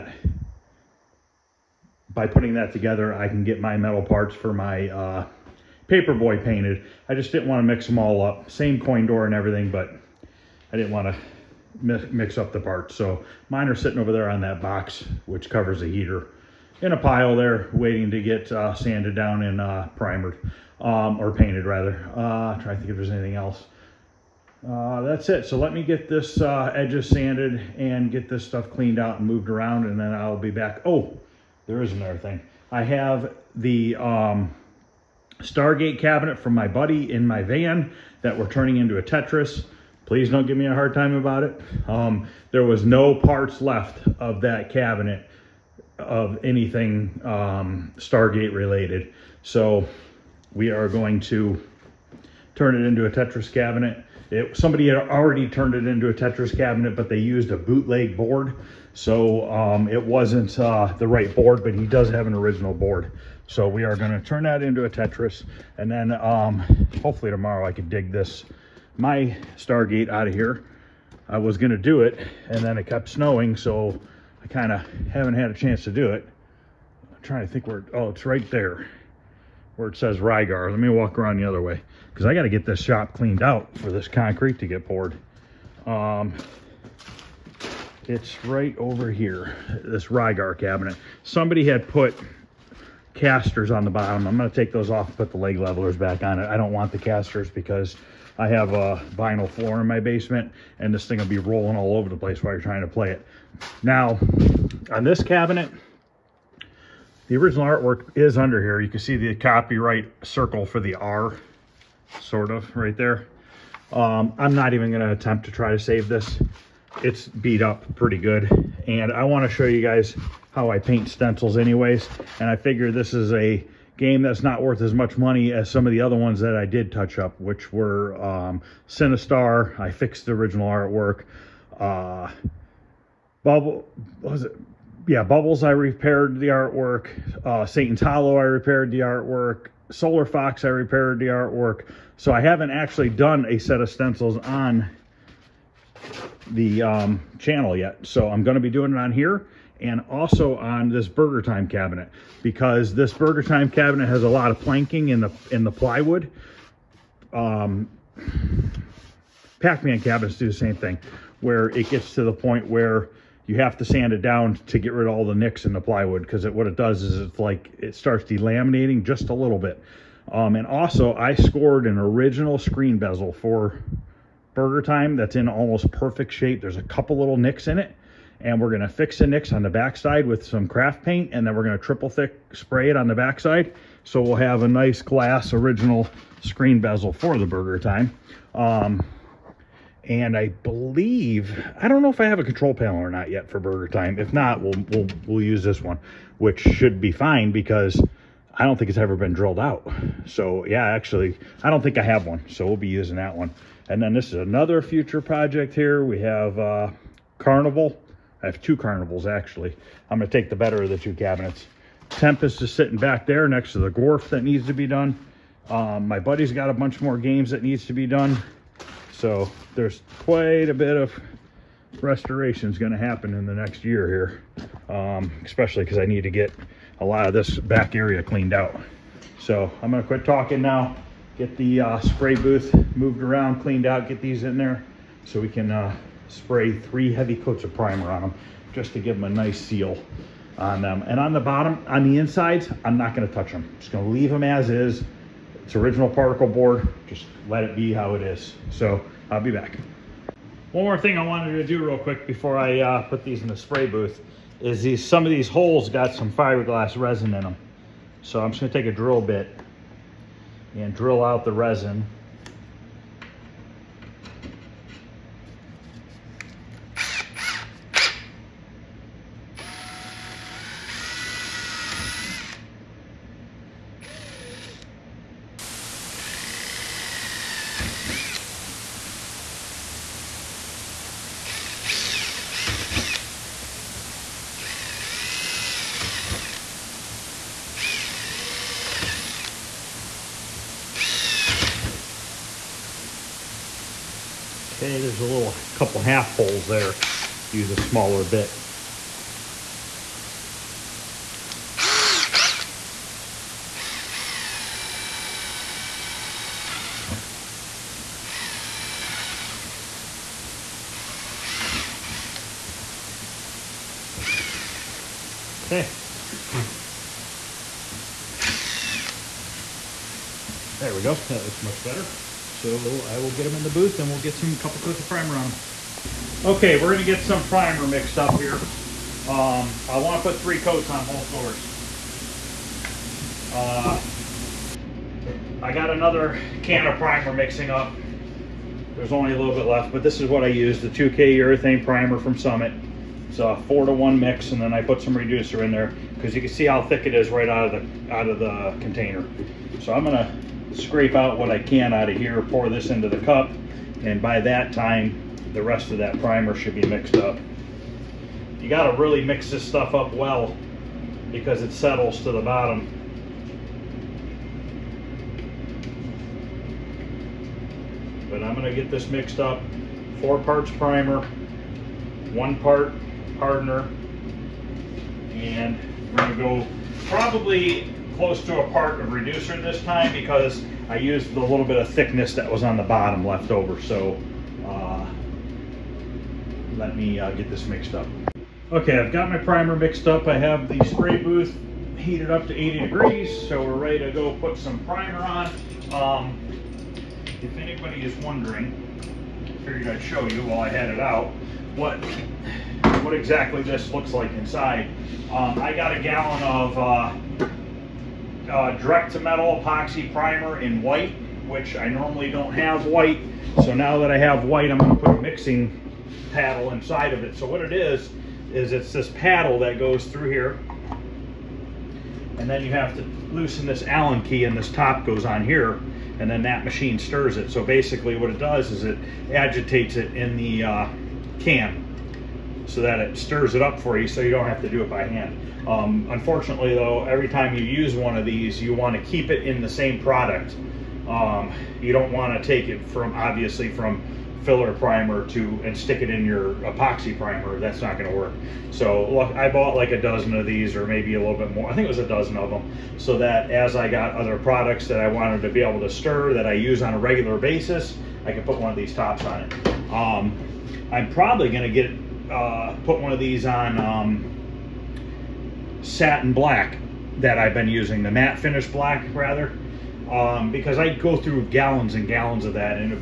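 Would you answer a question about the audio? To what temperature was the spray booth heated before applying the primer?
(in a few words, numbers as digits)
80 degrees.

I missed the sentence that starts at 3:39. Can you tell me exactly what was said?
So there's quite a bit of restoration is going to happen in the next year here.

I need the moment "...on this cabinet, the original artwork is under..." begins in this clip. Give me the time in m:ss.
1:44.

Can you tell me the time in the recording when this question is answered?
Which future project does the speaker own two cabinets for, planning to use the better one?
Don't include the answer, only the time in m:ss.
3:27.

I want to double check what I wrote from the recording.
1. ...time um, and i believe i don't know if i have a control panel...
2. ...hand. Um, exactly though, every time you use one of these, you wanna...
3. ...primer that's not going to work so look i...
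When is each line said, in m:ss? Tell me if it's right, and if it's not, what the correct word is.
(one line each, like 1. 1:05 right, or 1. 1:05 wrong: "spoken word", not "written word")
1. 3:07 right
2. 7:15 wrong: "unfortunately", not "exactly"
3. 7:27 right.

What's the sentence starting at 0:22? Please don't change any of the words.
Uh, trying to think if there's anything else.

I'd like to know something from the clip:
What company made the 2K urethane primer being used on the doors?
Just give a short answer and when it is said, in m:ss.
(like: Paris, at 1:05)
Summit, at 5:42.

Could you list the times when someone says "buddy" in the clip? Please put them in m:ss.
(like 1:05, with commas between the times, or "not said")
0:36, 3:36.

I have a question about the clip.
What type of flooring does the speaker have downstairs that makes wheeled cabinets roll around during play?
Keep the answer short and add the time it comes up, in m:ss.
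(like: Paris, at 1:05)
vinyl floor, at 1:39.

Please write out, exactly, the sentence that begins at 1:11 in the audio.
I was going to do it, and then it kept snowing, so I kind of haven't had a chance to do it.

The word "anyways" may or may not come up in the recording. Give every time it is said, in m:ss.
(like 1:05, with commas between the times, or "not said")
2:01.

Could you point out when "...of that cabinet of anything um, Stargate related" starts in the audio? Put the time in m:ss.
0:44.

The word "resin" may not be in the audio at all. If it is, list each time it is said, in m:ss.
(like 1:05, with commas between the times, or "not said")
4:16, 4:21.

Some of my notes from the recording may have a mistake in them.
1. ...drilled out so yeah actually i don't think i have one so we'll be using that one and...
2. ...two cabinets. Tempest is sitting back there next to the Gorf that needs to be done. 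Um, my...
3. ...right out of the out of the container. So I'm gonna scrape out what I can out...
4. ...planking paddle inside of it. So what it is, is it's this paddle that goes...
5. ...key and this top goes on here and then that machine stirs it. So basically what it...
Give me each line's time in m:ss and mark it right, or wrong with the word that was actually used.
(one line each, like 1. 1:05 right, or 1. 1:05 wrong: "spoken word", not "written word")
1. 3:19 right
2. 3:30 right
3. 5:47 right
4. 6:55 wrong: "mixing", not "planking"
5. 7:04 right.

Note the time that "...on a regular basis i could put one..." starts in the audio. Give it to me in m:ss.
7:36.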